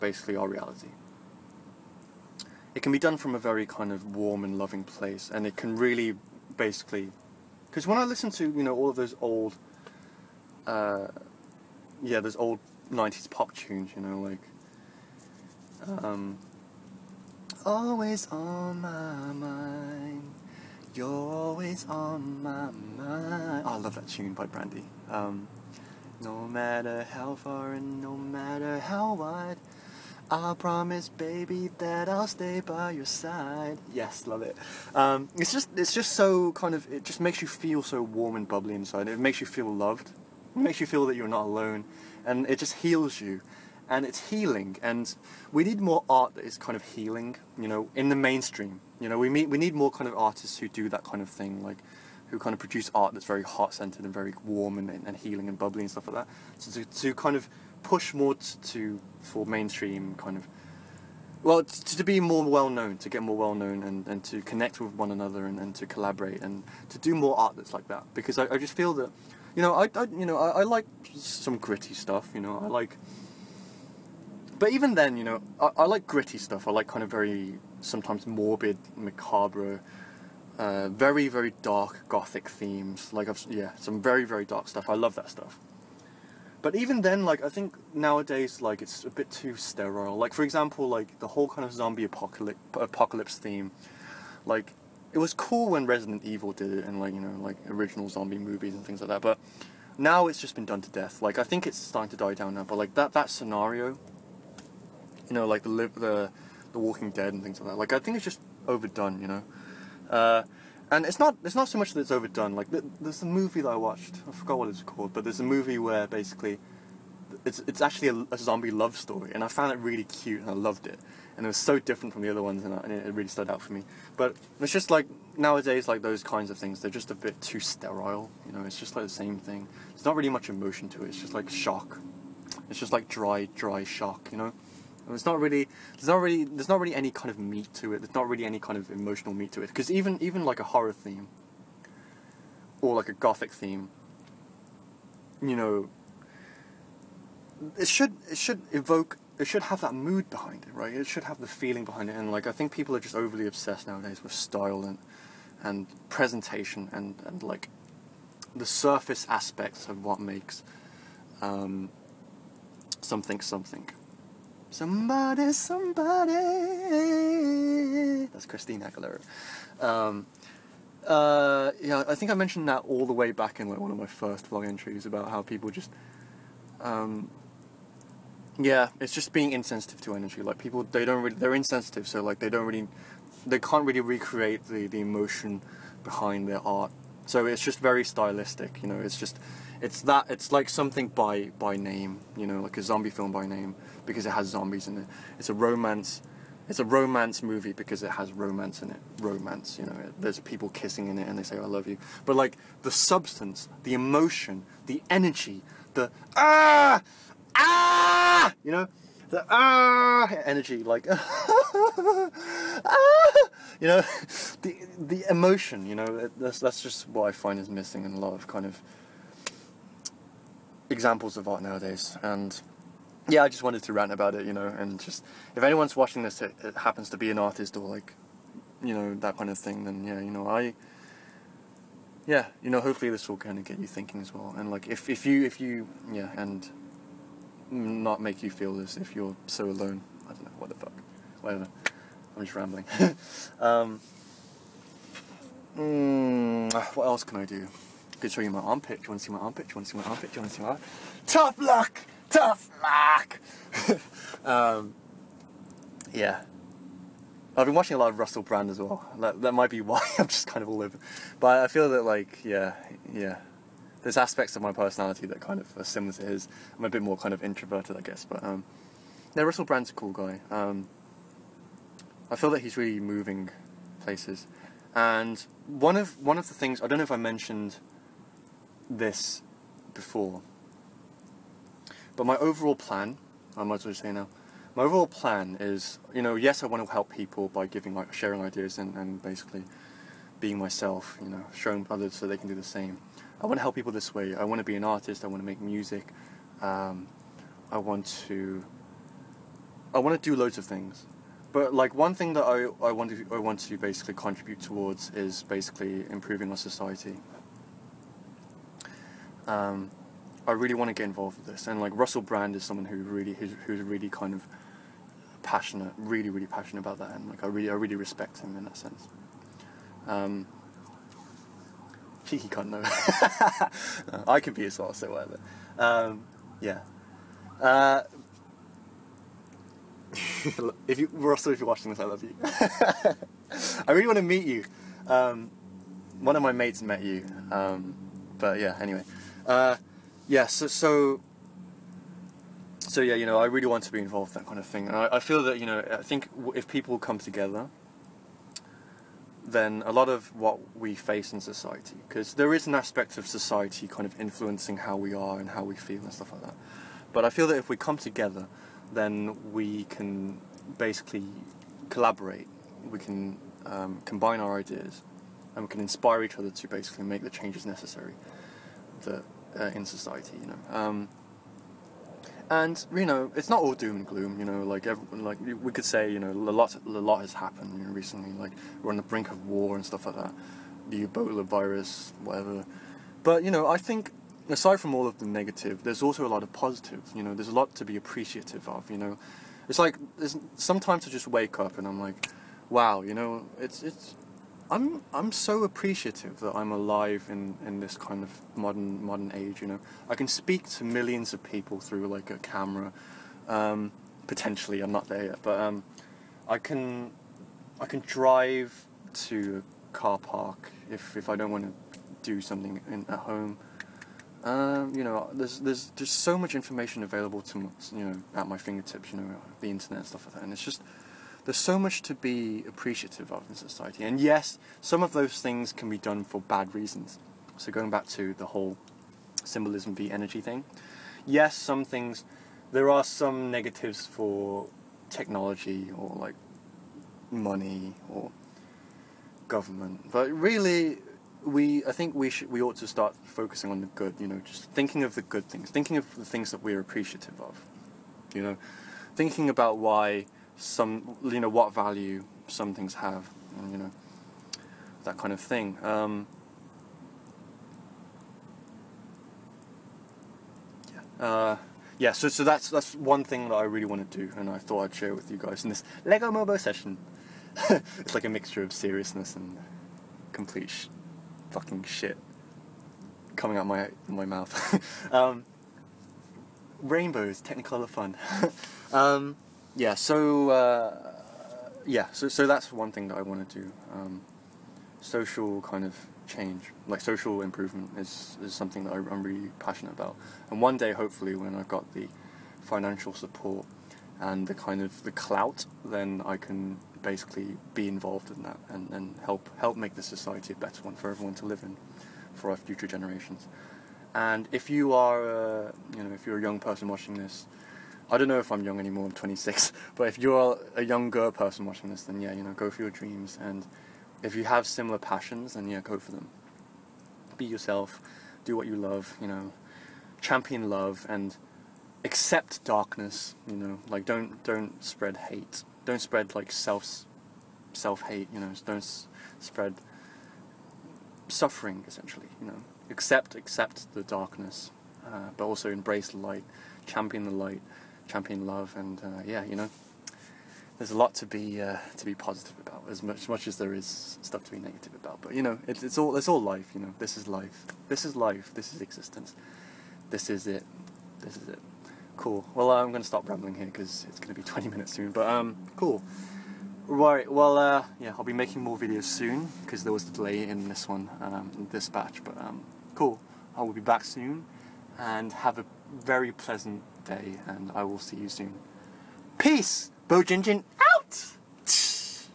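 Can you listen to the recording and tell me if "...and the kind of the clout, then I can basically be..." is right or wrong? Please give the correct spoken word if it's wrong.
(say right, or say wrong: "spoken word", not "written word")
right.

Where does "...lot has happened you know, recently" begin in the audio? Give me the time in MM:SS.
06:16.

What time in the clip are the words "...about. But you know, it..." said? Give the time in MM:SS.
09:04.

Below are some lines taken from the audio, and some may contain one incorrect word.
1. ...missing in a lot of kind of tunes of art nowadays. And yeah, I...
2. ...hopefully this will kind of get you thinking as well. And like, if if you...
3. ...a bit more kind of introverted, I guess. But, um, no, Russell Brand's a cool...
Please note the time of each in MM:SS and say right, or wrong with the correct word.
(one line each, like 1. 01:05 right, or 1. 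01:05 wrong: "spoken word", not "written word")
1. 03:37 wrong: "examples", not "tunes"
2. 03:52 right
3. 04:26 right.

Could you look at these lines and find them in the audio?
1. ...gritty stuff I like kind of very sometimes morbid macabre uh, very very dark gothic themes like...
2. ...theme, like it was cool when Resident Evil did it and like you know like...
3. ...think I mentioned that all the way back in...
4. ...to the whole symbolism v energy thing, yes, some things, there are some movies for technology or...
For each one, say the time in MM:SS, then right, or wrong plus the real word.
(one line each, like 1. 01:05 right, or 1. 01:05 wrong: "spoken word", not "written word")
1. 01:16 right
2. 01:33 right
3. 02:52 right
4. 07:08 wrong: "negatives", not "movies".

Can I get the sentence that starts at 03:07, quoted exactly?
So it's just very stylistic, you know.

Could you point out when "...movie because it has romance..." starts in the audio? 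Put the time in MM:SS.
03:17.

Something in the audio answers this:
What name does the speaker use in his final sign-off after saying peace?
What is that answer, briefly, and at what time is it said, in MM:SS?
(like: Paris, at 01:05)
Bowjinjin, at 09:30.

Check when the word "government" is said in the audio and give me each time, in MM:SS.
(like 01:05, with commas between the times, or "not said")
07:19.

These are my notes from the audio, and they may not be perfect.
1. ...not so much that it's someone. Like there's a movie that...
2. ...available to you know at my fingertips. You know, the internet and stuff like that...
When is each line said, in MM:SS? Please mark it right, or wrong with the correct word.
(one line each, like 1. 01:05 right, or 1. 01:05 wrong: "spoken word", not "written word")
1. 01:51 wrong: "overdone", not "someone"
2. 06:57 right.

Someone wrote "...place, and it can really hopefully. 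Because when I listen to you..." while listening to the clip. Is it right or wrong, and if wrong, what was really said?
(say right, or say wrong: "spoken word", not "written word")
wrong: "basically", not "hopefully".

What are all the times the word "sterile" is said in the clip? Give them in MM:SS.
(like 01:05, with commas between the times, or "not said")
01:29, 02:07.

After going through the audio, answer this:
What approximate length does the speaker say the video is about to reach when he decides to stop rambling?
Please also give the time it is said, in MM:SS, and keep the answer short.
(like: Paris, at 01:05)
20 minutes, at 09:14.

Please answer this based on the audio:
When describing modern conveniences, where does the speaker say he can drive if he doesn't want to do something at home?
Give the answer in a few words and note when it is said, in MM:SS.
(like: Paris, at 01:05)
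A car park, at 06:49.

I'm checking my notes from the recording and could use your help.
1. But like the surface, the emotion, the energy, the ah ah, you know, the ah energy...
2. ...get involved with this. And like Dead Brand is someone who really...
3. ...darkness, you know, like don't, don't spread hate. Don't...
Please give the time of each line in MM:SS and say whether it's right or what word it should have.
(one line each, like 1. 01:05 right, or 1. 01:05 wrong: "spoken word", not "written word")
1. 03:22 wrong: "substance", not "surface"
2. 05:10 wrong: "Russell", not "Dead"
3. 08:42 right.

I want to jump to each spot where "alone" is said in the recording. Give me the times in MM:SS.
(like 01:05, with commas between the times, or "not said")
00:41, 03:59.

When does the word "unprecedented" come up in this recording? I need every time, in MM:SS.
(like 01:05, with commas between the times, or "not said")
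not said.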